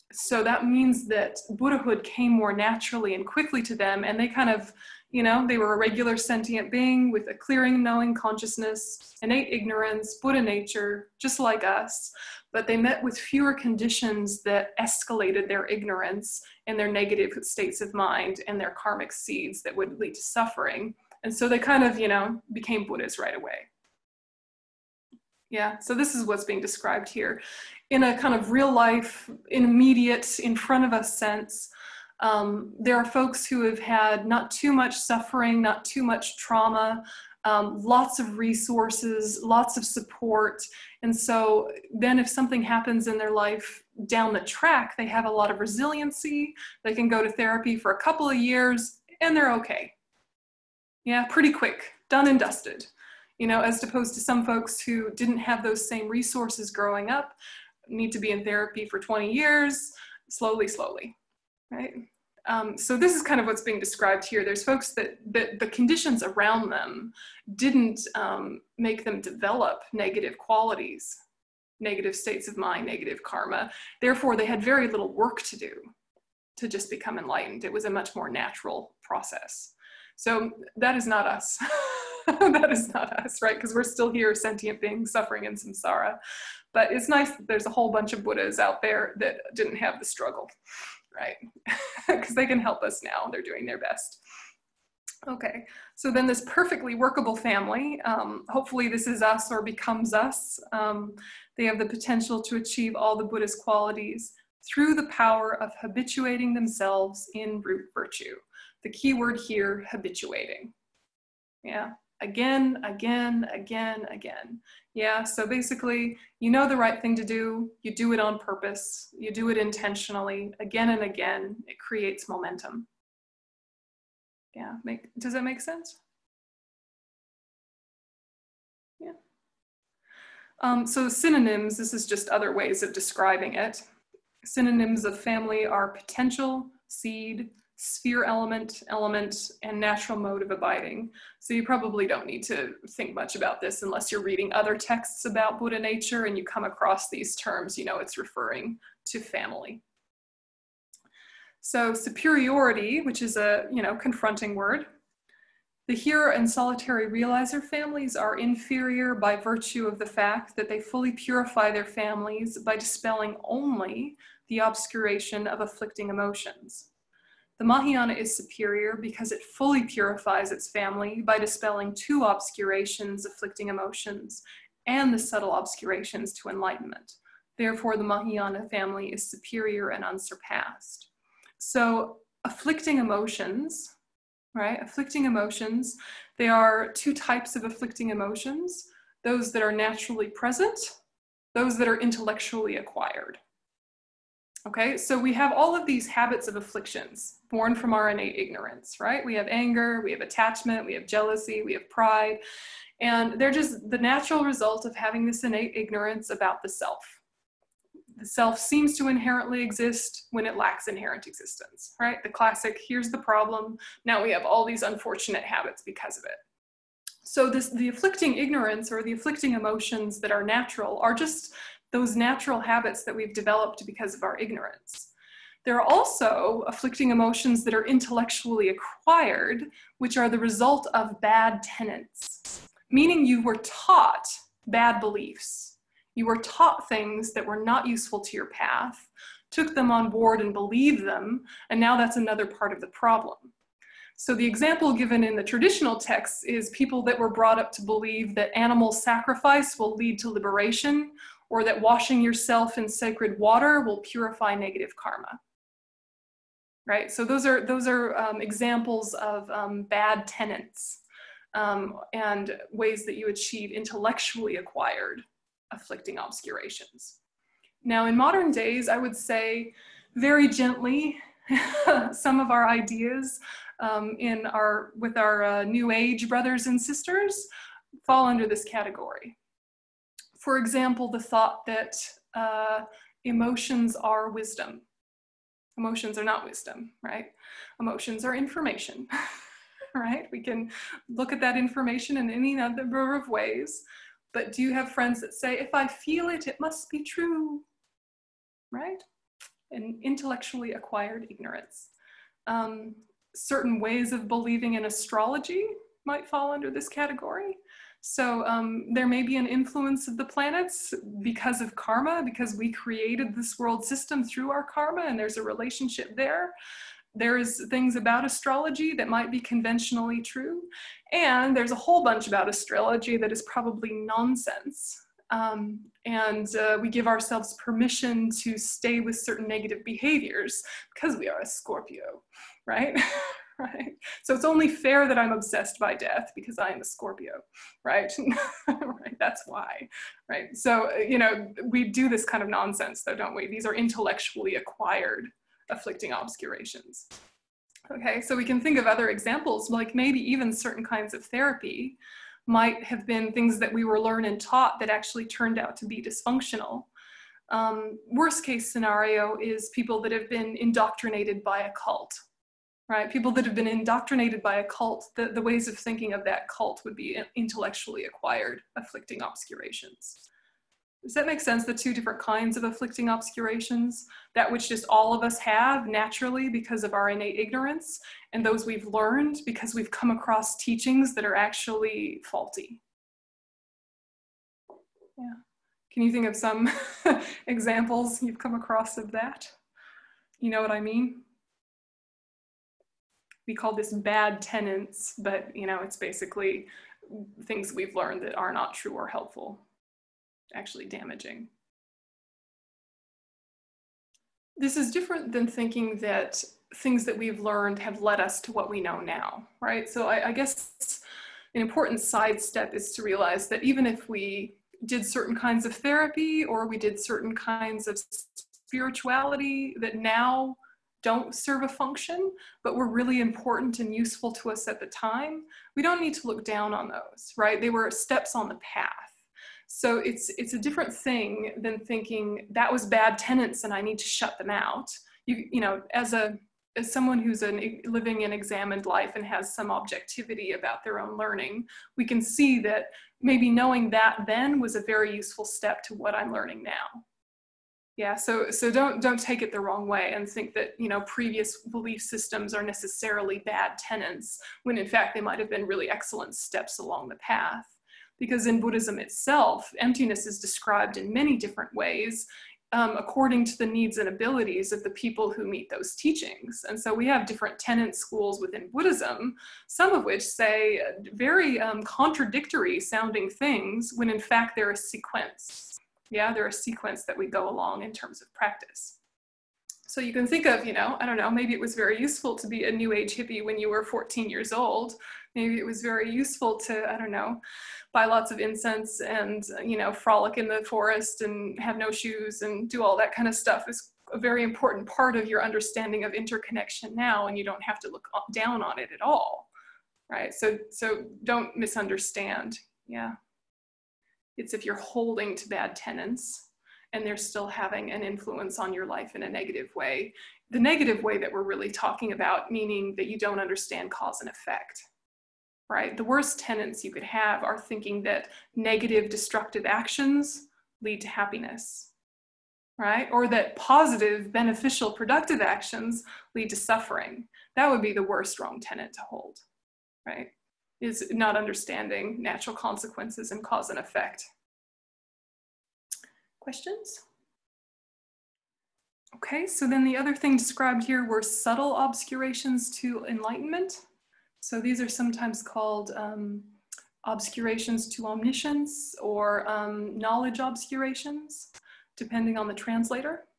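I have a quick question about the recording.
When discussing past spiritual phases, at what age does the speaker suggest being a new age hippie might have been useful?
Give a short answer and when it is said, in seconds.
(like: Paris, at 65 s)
14, at 483 s.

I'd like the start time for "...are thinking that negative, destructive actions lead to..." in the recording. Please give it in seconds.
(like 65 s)
517 s.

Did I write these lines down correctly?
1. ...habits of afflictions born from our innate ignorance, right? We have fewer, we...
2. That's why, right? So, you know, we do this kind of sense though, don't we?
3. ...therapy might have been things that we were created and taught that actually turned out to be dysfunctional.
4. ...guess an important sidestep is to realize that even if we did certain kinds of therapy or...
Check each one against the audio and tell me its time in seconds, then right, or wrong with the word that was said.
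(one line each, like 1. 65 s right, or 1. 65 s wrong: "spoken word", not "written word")
1. 196 s wrong: "anger", not "fewer"
2. 339 s wrong: "nonsense", not "sense"
3. 351 s wrong: "learned", not "created"
4. 410 s right.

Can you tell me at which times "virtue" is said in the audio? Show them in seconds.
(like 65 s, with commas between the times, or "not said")
107 s, 159 s.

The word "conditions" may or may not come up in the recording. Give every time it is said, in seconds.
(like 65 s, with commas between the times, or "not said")
13 s, 65 s.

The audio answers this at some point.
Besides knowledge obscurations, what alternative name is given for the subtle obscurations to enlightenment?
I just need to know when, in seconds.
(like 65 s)
547 s.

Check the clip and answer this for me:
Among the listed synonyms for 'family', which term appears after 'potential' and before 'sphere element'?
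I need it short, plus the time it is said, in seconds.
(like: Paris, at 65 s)
Seed, at 136 s.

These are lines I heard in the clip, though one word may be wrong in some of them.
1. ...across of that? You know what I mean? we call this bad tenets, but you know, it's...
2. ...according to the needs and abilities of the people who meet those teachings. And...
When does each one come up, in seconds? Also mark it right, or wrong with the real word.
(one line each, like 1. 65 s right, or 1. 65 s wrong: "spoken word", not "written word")
1. 388 s right
2. 462 s right.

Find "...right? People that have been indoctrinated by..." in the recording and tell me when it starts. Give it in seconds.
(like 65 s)
362 s.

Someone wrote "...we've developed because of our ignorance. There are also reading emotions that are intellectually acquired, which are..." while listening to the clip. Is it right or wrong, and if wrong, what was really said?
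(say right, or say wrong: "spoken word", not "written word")
wrong: "afflicting", not "reading".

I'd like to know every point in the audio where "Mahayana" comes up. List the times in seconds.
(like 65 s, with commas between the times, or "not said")
167 s, 178 s.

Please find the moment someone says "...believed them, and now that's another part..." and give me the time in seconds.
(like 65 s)
240 s.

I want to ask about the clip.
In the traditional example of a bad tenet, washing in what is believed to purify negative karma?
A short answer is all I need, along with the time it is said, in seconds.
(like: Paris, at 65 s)
Sacred water, at 252 s.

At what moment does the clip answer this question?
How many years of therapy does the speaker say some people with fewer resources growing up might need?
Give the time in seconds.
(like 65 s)
59 s.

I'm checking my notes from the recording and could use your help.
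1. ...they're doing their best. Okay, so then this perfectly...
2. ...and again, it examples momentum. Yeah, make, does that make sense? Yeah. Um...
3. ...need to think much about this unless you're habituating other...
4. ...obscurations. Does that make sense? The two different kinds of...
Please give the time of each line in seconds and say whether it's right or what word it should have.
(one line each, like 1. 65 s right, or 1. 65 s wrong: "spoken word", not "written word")
1. 93 s right
2. 120 s wrong: "creates", not "examples"
3. 142 s wrong: "reading", not "habituating"
4. 369 s right.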